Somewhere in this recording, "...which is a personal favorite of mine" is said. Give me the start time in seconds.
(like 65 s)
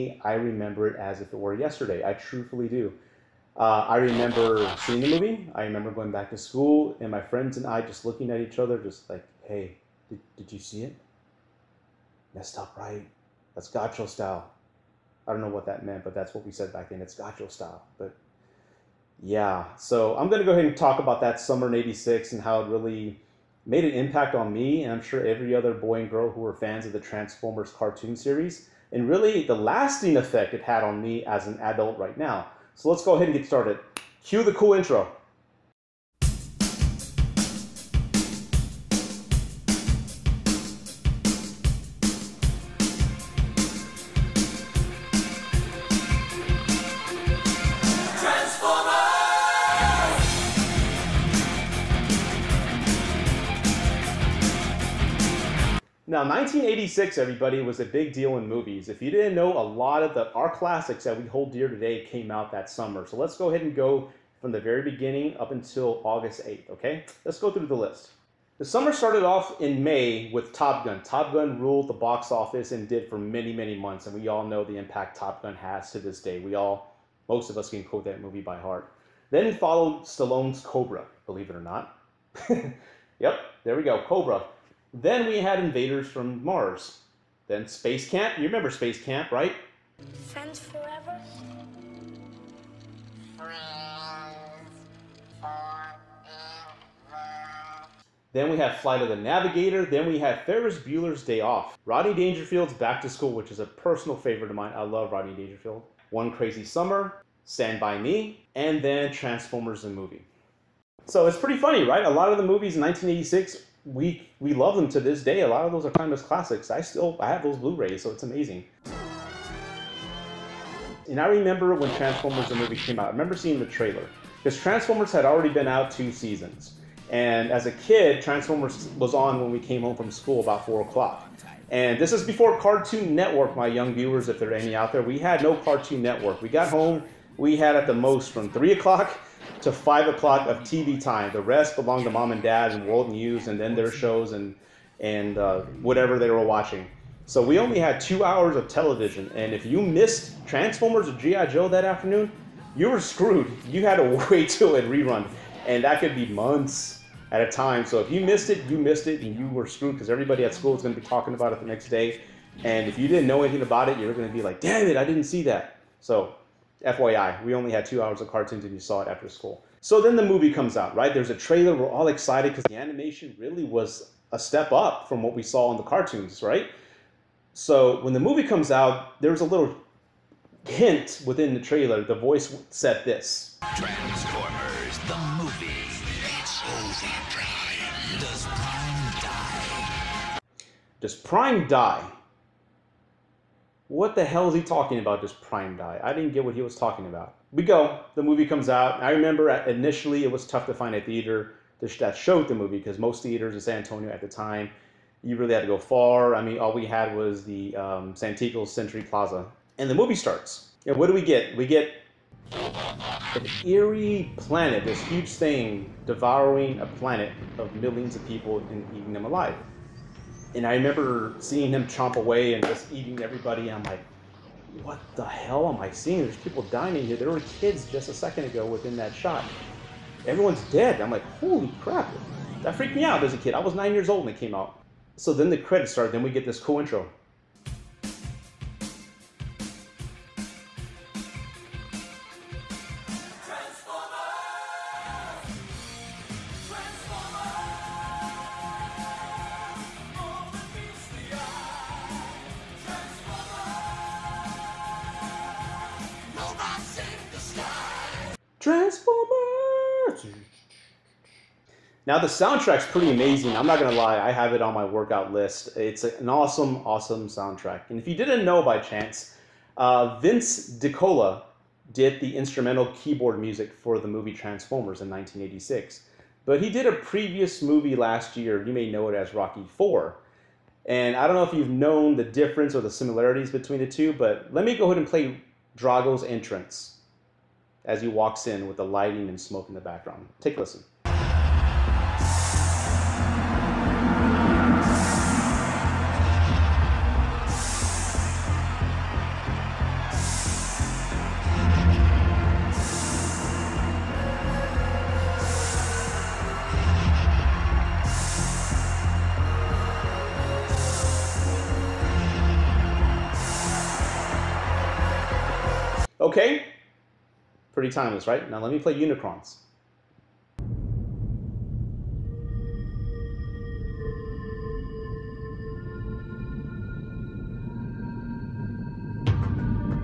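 103 s.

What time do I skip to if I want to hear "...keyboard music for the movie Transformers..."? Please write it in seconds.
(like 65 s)
272 s.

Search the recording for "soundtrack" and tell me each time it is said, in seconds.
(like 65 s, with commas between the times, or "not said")
262 s, 267 s.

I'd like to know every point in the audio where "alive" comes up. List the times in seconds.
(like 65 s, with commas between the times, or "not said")
219 s.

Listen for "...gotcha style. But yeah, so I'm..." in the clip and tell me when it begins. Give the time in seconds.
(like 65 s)
17 s.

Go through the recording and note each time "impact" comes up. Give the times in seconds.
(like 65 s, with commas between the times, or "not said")
23 s, 74 s.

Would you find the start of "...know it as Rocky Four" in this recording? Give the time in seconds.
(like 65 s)
278 s.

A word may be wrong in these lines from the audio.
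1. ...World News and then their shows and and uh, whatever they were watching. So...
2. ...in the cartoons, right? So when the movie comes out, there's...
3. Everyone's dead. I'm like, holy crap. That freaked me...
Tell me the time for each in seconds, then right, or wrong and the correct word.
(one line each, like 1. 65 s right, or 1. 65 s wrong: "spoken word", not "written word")
1. 142 s right
2. 175 s right
3. 230 s right.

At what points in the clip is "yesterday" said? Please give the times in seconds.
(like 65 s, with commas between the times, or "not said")
1 s.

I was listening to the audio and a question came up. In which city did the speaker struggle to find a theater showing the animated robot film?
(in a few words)
San Antonio.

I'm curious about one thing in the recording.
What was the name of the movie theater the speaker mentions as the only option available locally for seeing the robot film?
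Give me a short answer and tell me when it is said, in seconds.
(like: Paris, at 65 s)
Santikos Century Plaza, at 208 s.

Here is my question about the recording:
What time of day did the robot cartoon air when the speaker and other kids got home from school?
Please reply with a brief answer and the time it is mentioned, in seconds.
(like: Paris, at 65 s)
4:00, at 130 s.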